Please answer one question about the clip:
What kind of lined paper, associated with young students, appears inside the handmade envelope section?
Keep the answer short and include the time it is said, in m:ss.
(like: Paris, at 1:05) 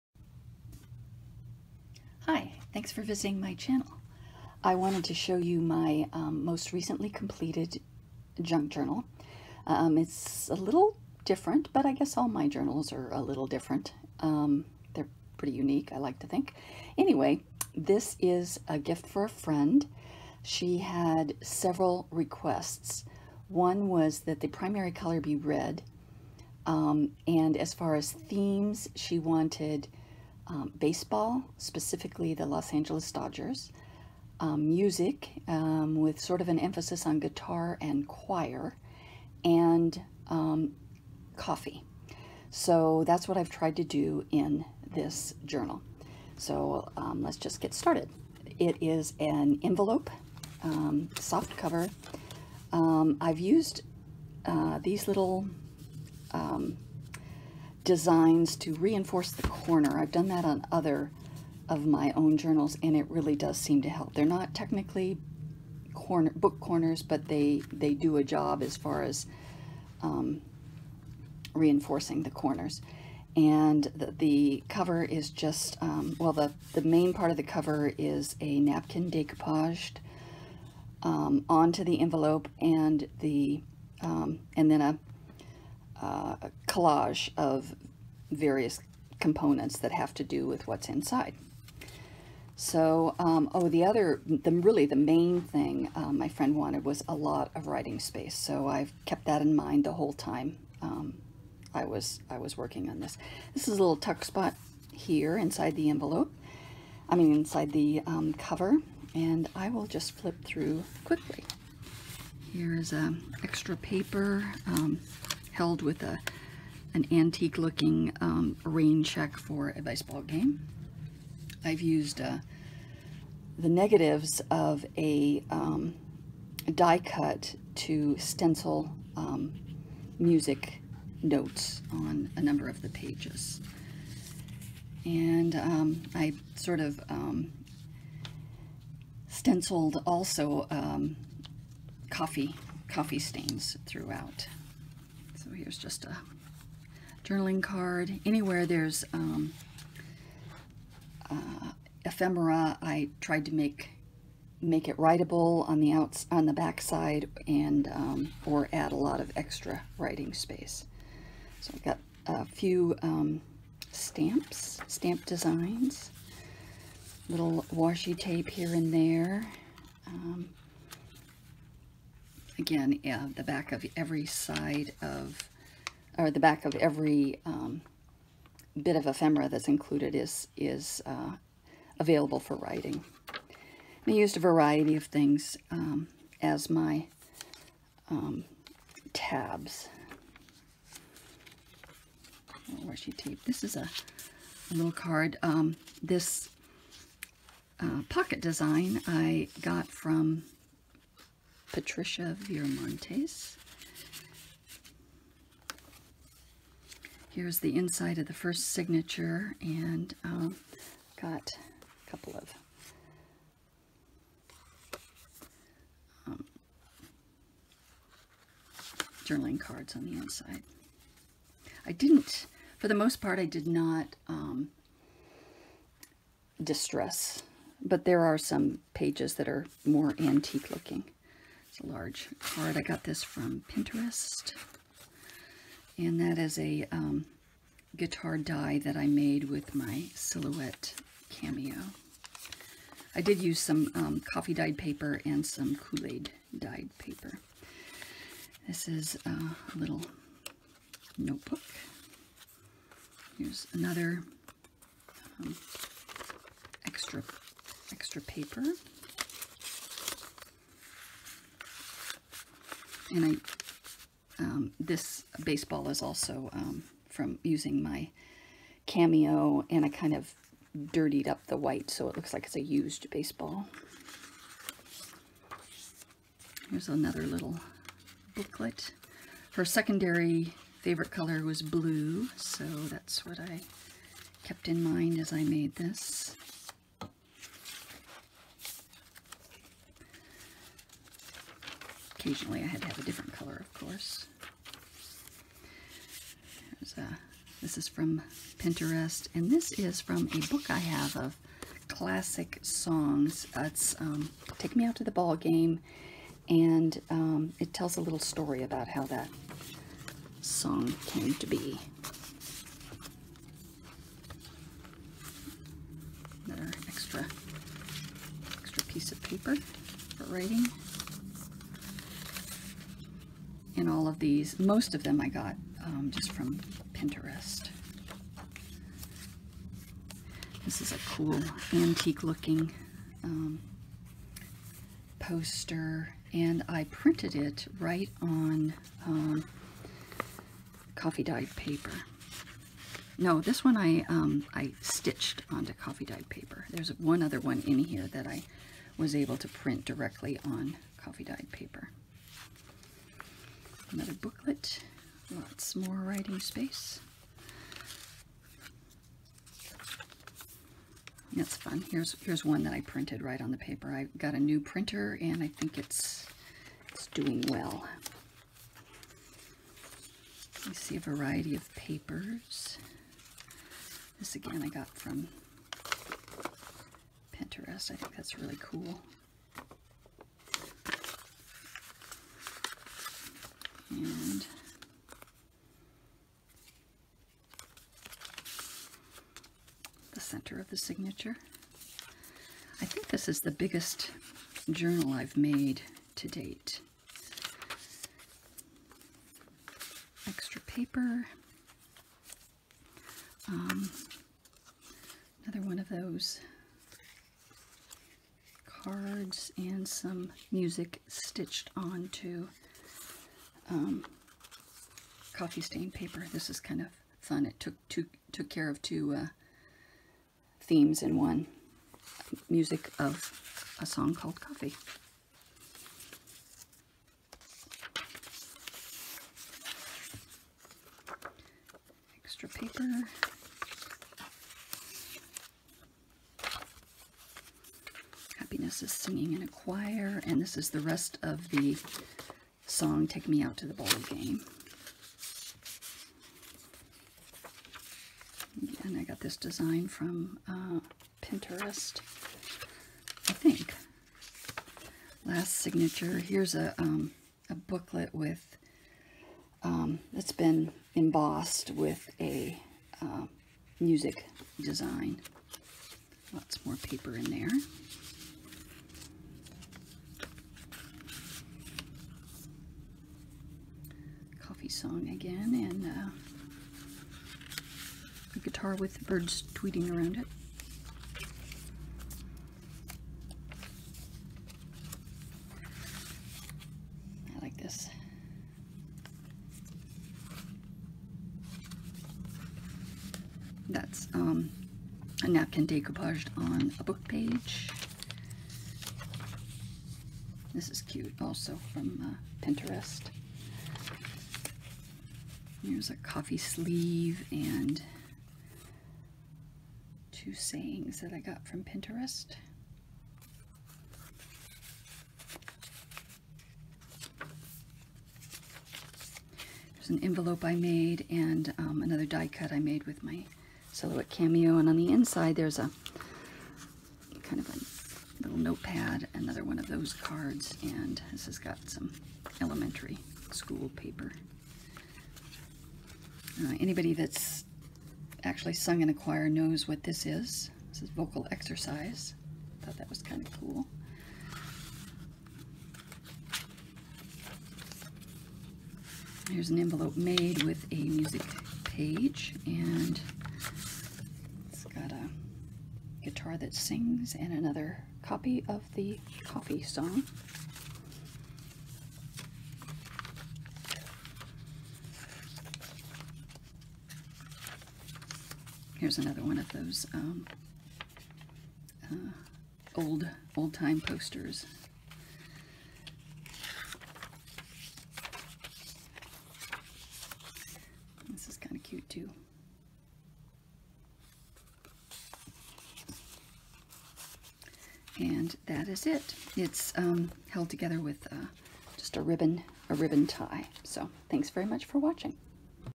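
Elementary school paper, at 8:52.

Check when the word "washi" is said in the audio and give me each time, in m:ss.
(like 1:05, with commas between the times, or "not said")
2:47, 3:12.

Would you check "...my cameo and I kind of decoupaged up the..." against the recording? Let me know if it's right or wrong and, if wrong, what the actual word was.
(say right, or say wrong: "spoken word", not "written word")
wrong: "dirtied", not "decoupaged".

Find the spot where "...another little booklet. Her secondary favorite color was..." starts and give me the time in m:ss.
4:36.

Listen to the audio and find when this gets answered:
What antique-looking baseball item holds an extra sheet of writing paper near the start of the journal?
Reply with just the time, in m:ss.
1:58.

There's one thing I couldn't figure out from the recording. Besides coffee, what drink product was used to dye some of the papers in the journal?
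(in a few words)
Kool-Aid.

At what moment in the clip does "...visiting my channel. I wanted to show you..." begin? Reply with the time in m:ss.
0:03.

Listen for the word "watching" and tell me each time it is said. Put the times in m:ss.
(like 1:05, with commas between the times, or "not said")
9:54.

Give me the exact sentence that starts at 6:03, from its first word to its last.
I got a new printer and I think it's it's doing well.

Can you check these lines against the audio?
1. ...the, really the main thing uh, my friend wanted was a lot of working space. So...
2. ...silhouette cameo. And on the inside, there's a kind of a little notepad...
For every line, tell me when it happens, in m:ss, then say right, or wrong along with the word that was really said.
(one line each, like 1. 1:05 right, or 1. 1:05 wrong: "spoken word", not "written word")
1. 1:34 wrong: "writing", not "working"
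2. 8:43 right.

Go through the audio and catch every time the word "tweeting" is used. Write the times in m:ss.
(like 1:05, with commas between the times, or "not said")
7:59.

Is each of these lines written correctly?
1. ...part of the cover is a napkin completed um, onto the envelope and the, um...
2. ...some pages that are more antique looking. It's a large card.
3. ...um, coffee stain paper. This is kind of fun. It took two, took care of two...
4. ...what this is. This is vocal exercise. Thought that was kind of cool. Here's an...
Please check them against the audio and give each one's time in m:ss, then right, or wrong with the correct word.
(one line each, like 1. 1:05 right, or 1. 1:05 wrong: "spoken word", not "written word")
1. 1:17 wrong: "decoupaged", not "completed"
2. 3:48 right
3. 6:53 right
4. 8:59 right.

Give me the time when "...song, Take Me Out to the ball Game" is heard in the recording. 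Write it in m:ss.
7:22.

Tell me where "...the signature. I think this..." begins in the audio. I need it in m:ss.
6:30.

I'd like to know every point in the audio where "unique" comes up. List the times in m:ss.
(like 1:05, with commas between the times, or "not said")
0:15.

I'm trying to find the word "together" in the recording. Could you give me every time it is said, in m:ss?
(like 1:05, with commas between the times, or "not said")
9:50.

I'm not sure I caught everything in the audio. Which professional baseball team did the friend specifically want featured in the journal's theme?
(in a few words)
Los Angeles Dodgers.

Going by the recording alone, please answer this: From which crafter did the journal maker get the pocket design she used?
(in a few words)
Patricia Viramontes.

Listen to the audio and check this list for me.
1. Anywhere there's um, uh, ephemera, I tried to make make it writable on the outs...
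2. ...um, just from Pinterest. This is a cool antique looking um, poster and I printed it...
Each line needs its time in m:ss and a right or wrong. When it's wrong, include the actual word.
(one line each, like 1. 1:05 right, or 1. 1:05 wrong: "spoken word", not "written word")
1. 2:28 right
2. 5:25 right.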